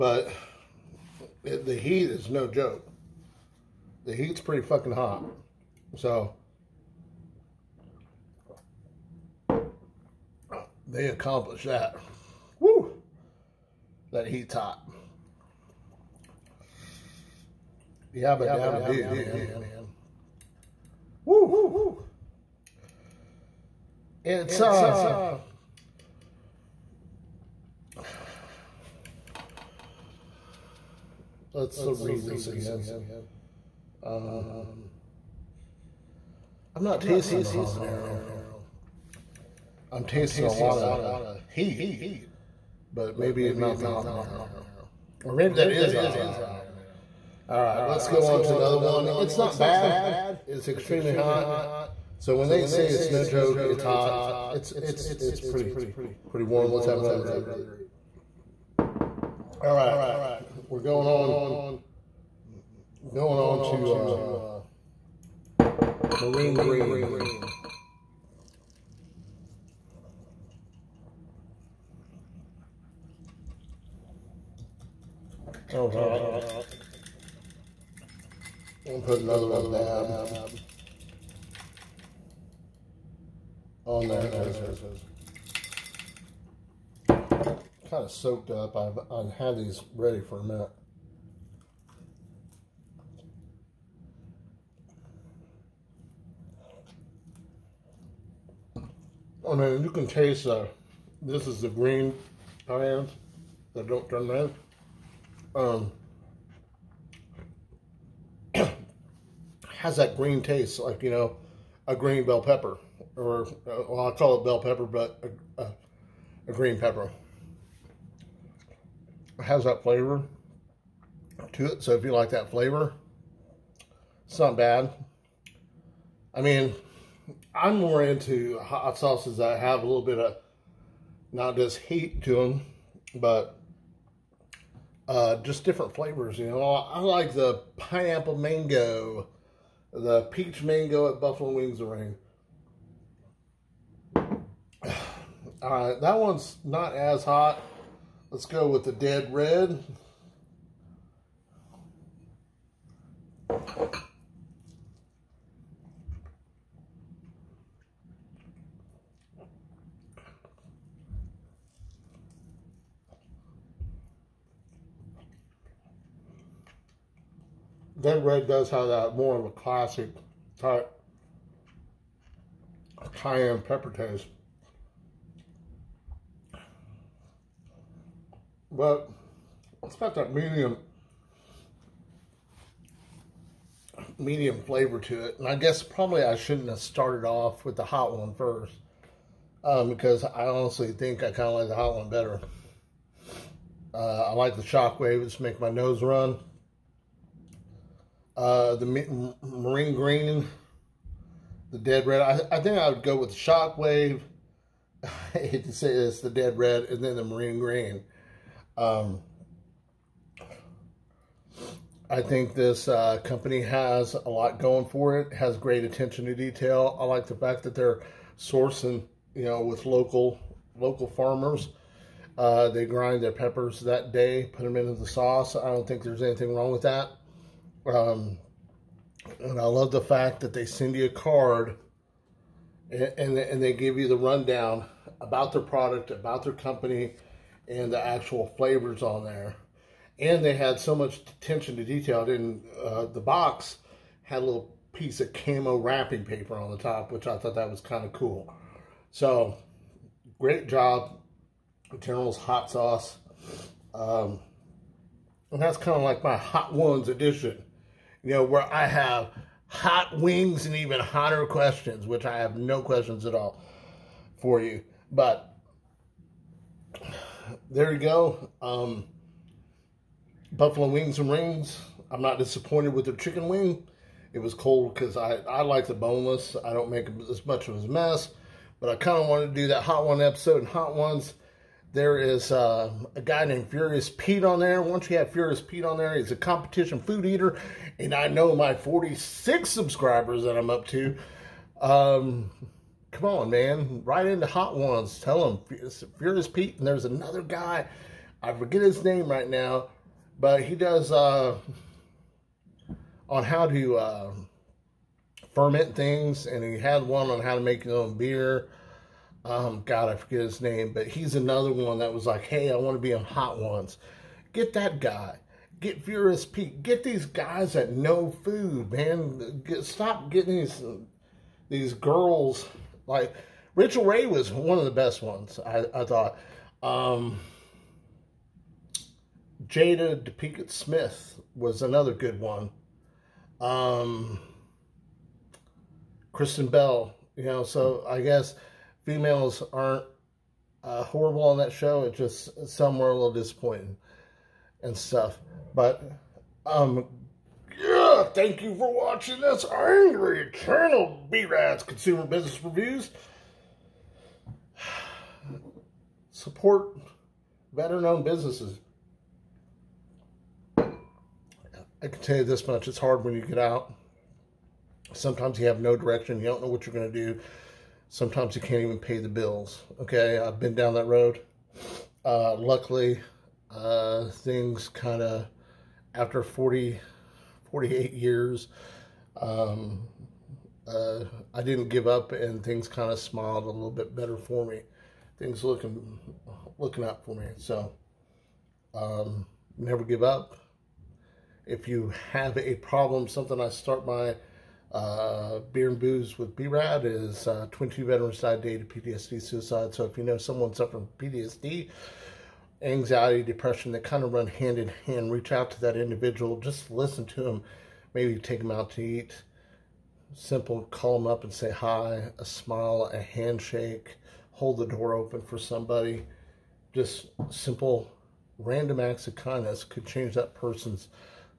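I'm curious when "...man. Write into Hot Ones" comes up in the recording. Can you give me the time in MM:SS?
04:53.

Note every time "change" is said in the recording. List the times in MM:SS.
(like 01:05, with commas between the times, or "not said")
07:00.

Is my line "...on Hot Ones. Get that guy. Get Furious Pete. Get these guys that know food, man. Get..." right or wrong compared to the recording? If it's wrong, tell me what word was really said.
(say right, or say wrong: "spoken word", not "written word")
right.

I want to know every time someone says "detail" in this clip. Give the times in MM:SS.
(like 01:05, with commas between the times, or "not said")
03:36, 04:01.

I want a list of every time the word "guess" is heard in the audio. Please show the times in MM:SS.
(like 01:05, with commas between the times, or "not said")
03:05, 05:38.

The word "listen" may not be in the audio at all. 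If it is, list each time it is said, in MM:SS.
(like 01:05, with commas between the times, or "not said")
06:46.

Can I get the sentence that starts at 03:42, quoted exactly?
Uh, they grind their peppers that day, put them into the sauce.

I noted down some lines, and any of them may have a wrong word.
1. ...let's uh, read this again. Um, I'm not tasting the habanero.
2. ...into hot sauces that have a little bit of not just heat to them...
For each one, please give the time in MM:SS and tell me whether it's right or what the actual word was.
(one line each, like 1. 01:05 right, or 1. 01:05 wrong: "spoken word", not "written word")
1. 00:31 right
2. 02:08 right.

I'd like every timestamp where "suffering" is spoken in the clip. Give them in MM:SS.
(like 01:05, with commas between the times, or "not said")
06:40.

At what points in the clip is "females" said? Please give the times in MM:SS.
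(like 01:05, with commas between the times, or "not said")
05:39.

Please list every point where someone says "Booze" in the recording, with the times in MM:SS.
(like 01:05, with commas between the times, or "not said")
06:35.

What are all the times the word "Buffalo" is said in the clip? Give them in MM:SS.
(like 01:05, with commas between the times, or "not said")
02:21, 04:30.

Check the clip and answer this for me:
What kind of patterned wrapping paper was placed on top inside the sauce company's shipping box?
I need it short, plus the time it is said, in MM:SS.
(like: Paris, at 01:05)
camo, at 04:05.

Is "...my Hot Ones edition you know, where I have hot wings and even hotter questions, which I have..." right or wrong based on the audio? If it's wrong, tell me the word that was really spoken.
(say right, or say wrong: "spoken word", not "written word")
right.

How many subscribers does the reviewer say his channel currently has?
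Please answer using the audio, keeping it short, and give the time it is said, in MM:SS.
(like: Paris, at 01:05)
46, at 04:48.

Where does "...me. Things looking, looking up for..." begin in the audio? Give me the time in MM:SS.
06:24.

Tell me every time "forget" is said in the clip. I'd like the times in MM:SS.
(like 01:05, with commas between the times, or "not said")
04:58, 05:10.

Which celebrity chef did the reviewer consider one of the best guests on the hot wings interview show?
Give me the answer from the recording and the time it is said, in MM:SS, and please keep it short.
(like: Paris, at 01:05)
Rachael Ray, at 05:23.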